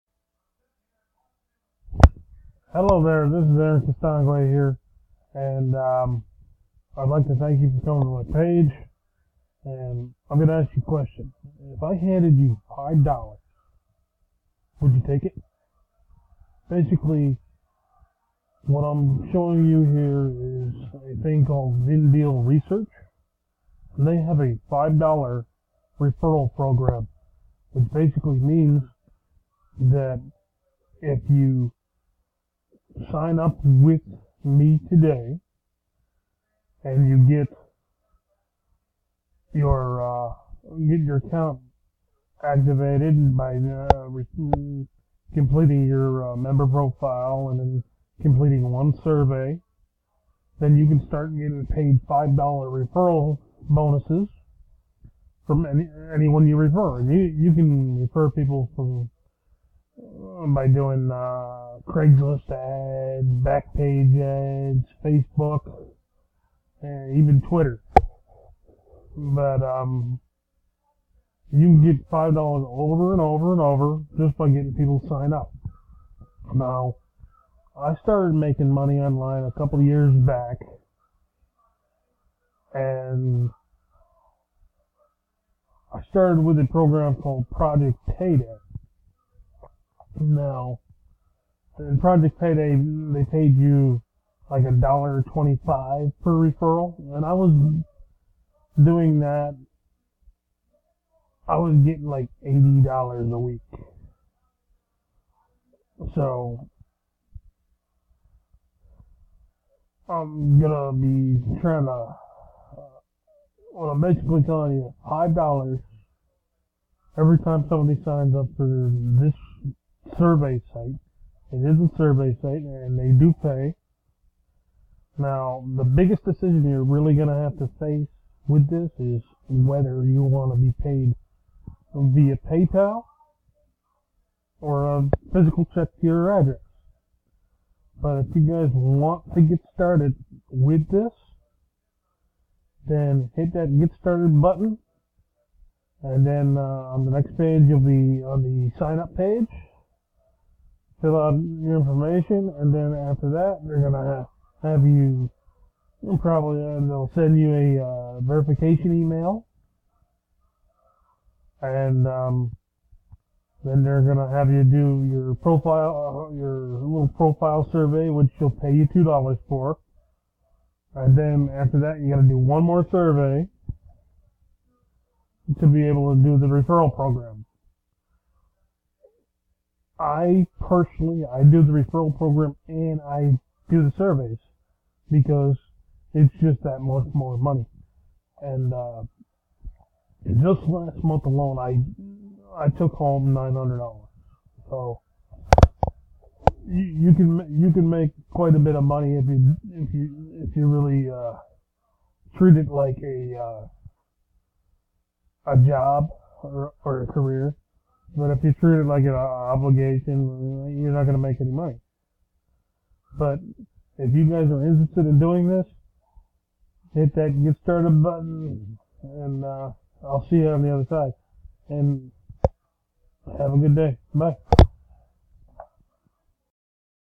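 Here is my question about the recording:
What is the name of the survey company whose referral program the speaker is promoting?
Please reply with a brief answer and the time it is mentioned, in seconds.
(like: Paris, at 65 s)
Vindale Research, at 21 s.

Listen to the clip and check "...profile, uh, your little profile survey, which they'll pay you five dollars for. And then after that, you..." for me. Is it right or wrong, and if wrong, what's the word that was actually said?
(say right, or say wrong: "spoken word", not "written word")
wrong: "two", not "five".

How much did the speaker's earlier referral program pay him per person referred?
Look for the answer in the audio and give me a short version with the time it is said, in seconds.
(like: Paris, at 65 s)
$1.25, at 94 s.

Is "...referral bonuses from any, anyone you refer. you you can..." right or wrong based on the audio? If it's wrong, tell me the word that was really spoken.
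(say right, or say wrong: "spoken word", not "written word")
right.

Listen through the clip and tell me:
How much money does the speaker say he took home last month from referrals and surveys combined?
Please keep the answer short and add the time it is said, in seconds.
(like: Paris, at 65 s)
$900, at 193 s.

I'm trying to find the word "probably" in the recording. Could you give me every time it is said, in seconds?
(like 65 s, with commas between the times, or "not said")
156 s.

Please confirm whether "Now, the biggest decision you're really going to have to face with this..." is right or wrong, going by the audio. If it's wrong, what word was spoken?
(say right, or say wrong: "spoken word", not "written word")
right.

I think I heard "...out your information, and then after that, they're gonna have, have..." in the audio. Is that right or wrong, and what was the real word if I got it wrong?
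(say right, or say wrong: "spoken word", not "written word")
right.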